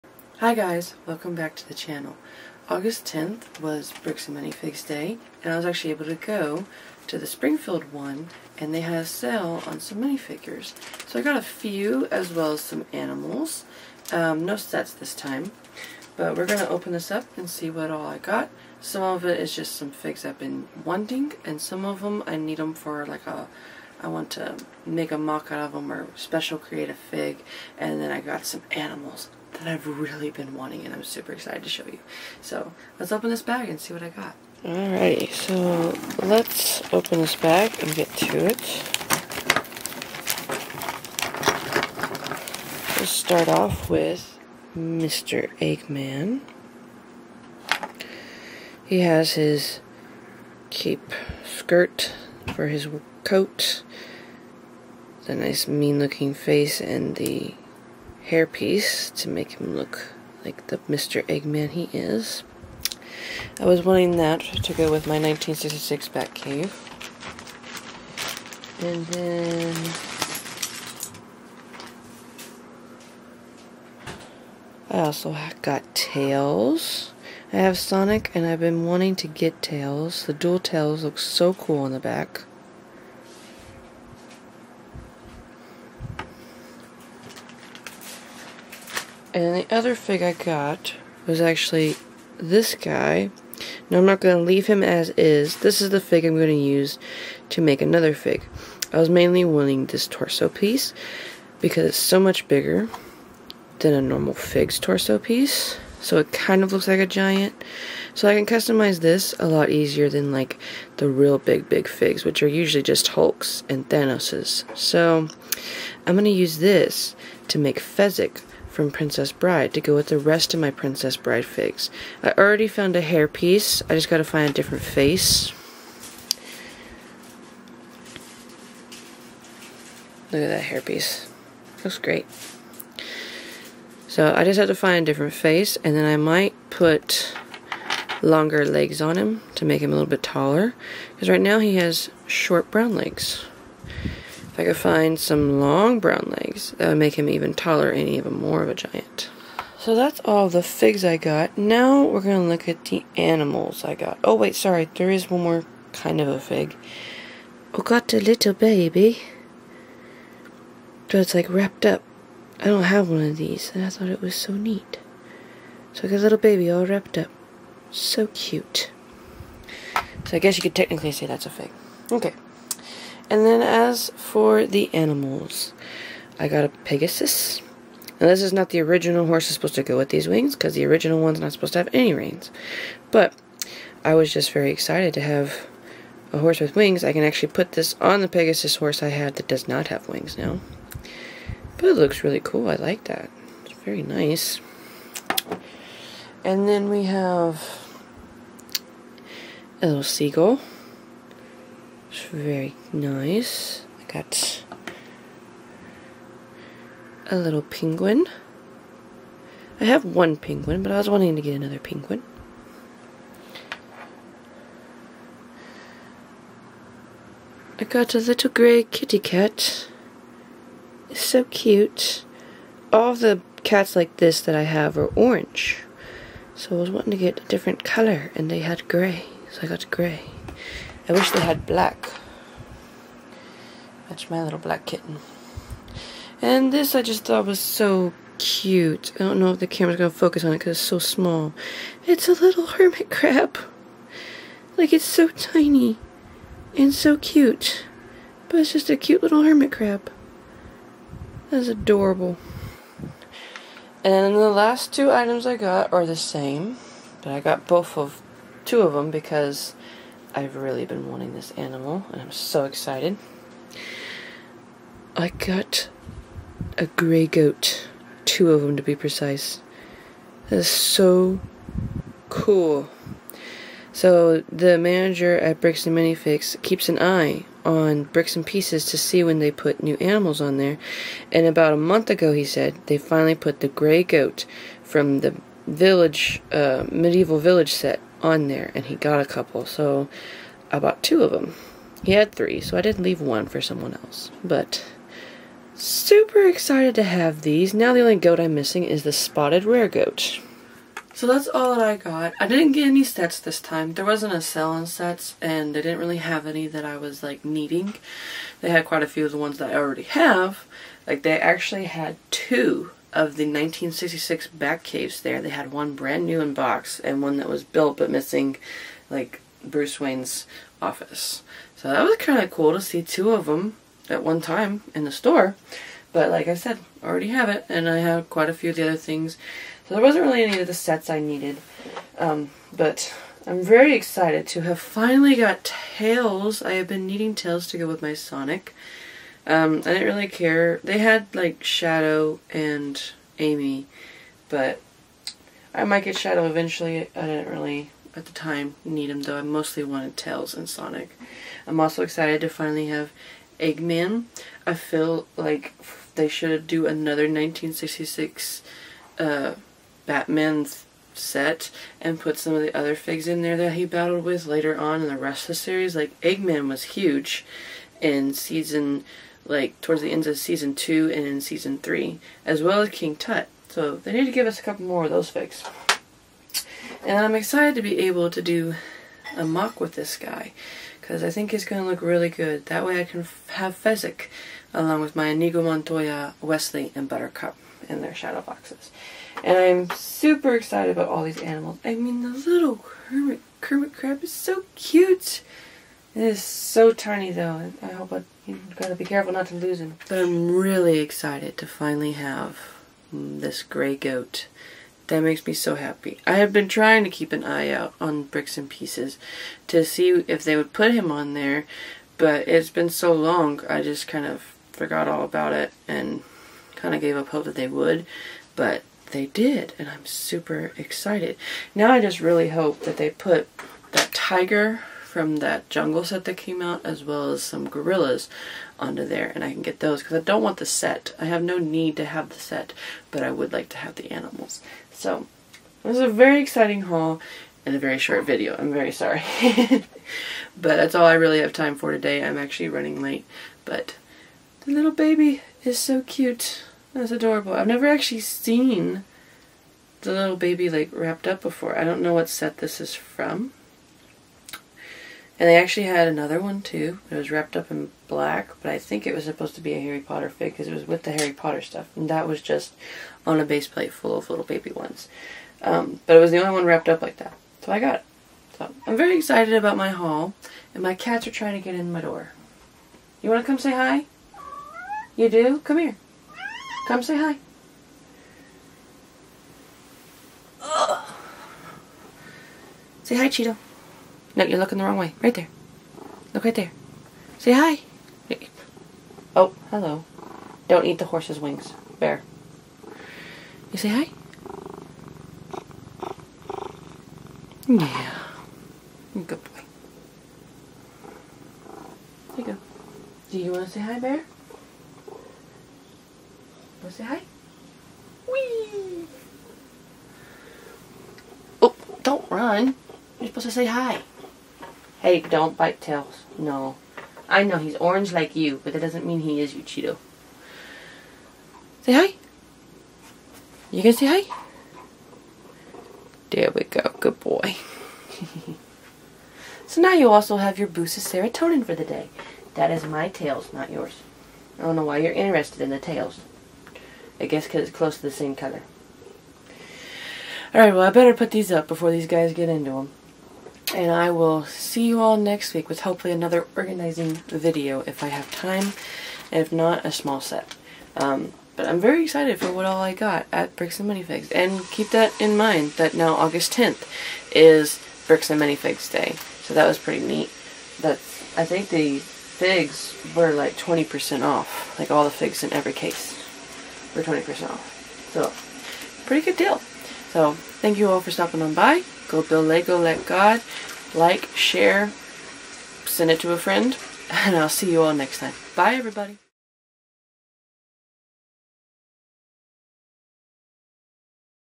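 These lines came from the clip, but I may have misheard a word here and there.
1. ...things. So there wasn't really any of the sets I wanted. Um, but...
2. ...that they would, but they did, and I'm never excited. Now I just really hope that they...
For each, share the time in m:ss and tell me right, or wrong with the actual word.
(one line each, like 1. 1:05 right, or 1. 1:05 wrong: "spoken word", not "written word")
1. 5:28 wrong: "needed", not "wanted"
2. 6:57 wrong: "super", not "never".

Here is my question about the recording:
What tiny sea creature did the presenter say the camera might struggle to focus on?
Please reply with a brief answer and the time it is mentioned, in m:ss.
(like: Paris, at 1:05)
Hermit crab, at 4:02.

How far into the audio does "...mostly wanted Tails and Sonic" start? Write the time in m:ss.
5:49.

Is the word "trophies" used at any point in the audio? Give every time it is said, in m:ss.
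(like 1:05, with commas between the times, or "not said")
not said.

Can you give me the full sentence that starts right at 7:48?
So I'm very excited about my haul.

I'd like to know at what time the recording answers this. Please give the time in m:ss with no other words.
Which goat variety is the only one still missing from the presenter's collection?
4:59.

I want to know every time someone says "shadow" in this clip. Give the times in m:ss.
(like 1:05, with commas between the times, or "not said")
5:41, 5:46, 6:28.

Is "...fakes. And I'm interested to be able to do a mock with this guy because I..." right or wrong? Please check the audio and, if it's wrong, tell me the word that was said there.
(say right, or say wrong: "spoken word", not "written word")
wrong: "excited", not "interested".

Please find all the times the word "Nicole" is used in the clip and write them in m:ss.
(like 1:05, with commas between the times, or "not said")
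not said.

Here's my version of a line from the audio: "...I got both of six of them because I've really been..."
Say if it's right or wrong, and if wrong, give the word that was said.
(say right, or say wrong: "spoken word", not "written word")
wrong: "two", not "six".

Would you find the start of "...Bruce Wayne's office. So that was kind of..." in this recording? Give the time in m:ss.
5:19.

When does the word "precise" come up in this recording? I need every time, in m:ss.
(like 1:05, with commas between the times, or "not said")
4:28.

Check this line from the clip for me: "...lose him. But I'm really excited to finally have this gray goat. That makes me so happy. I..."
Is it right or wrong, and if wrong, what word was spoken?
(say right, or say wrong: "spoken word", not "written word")
right.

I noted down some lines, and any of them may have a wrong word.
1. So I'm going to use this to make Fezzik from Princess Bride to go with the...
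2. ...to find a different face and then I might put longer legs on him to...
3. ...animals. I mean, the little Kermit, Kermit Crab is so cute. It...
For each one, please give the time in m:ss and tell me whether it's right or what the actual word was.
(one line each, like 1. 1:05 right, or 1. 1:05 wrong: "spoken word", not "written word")
1. 1:54 right
2. 2:14 right
3. 6:31 right.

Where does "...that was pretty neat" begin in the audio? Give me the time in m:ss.
9:19.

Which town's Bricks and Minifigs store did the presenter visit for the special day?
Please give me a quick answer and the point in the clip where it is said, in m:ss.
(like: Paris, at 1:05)
Springfield, at 0:07.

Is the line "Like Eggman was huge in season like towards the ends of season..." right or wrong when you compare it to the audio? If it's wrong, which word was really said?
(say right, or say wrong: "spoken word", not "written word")
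right.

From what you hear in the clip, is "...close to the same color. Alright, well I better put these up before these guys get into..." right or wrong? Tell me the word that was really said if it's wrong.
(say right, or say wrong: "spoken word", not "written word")
right.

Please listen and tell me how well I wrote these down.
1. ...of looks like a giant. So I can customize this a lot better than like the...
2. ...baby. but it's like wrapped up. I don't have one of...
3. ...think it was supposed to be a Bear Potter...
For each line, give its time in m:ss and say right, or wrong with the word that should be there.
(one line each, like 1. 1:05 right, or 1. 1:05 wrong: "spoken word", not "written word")
1. 1:46 wrong: "easier", not "better"
2. 2:38 right
3. 7:38 wrong: "Harry", not "Bear".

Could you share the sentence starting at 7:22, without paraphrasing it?
I'm actually running late but the little baby is so cute.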